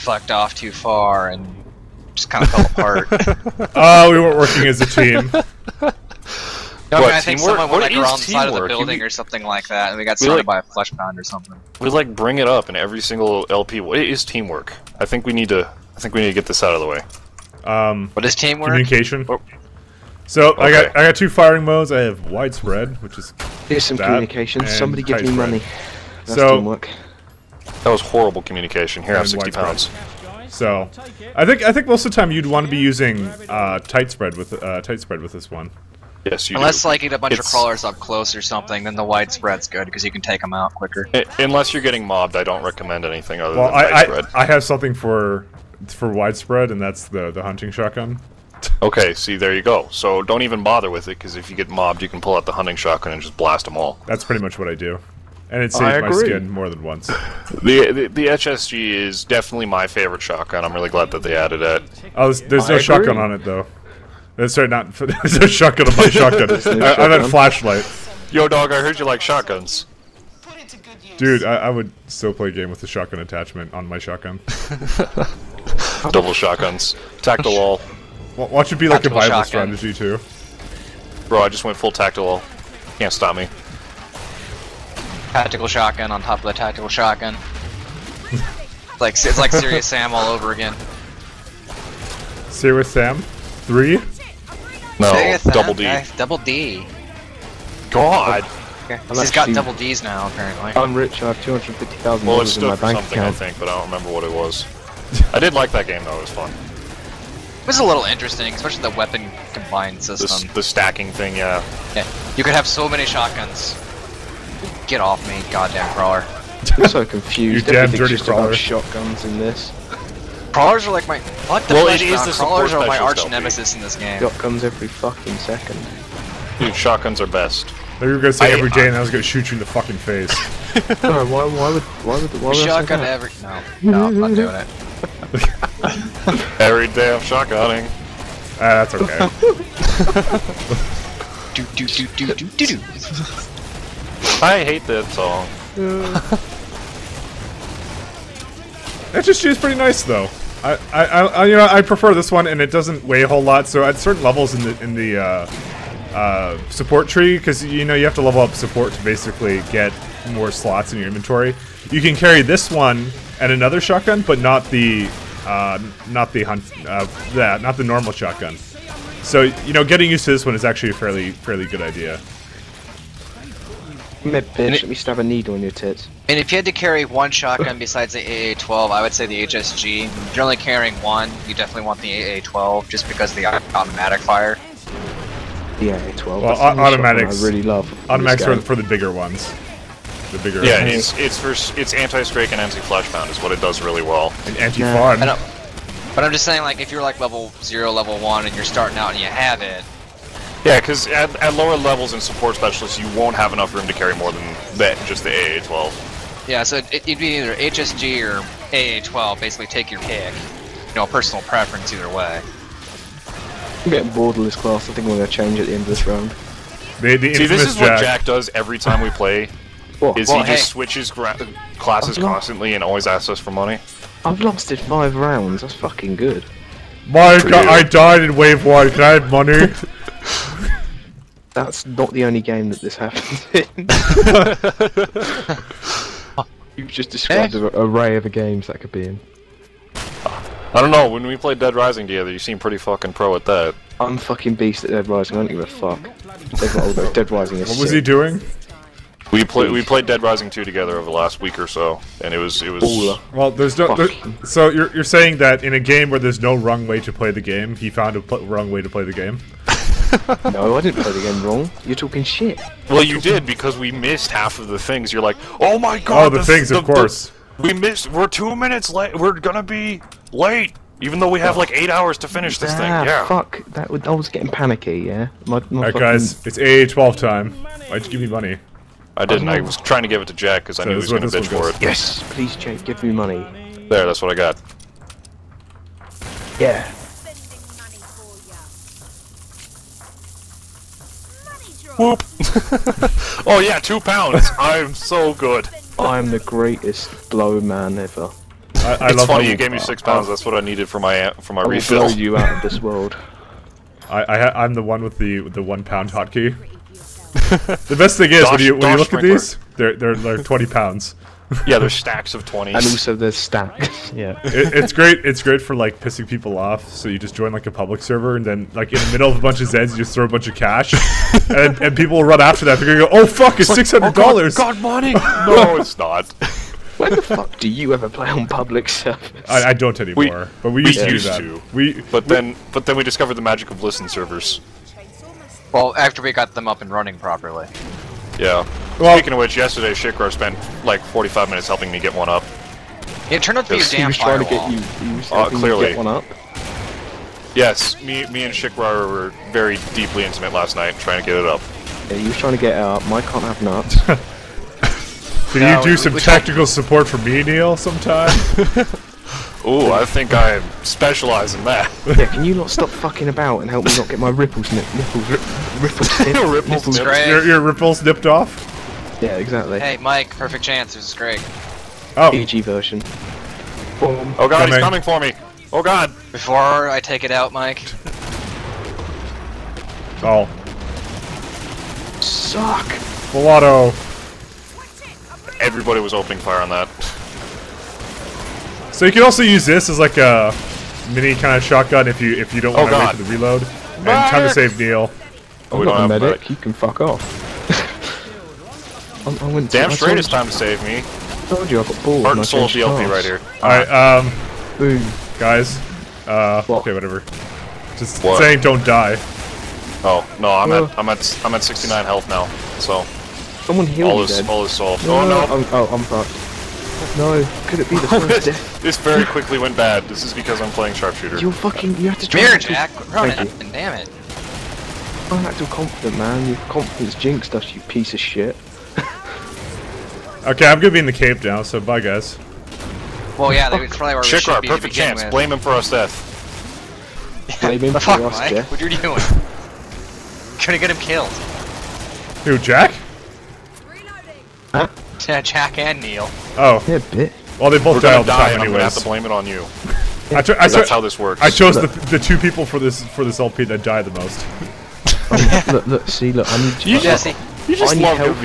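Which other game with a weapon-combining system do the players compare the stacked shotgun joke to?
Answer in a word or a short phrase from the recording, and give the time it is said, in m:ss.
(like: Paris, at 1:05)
Serious Sam, at 1:29.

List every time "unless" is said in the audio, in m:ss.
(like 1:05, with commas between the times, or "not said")
0:36, 0:41.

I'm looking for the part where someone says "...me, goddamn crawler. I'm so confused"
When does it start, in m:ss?
1:55.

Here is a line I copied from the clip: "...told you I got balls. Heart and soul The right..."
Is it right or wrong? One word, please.
wrong.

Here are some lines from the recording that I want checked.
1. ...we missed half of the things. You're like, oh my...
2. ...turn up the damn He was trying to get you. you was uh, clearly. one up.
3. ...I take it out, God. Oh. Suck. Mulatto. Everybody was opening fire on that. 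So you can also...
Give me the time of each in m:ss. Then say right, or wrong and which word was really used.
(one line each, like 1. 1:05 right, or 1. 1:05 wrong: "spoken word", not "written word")
1. 4:23 right
2. 5:43 right
3. 6:16 wrong: "Mike", not "God".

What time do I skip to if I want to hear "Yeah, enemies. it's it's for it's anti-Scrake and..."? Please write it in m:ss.
3:10.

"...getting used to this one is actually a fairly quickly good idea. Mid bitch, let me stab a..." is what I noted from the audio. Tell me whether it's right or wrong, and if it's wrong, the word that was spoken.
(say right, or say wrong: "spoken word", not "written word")
wrong: "fairly", not "quickly".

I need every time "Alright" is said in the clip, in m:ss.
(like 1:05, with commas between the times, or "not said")
4:35, 6:43.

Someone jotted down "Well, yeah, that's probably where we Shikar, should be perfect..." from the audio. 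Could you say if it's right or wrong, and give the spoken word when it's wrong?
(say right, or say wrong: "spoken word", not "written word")
right.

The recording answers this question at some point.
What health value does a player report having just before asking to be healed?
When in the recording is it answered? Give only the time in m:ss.
6:51.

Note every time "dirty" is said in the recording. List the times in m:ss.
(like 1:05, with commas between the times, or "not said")
1:57.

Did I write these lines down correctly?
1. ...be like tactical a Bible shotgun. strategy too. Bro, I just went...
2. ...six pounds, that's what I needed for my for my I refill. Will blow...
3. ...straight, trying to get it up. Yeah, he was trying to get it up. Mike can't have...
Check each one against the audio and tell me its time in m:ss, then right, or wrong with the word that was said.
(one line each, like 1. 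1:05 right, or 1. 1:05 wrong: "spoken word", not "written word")
1. 1:18 right
2. 4:59 right
3. 5:50 wrong: "night", not "straight".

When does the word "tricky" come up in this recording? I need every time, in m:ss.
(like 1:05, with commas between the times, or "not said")
not said.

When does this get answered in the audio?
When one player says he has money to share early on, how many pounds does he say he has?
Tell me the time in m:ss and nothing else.
0:29.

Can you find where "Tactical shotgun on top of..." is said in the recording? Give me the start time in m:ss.
1:25.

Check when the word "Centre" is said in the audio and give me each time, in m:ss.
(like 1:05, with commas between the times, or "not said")
not said.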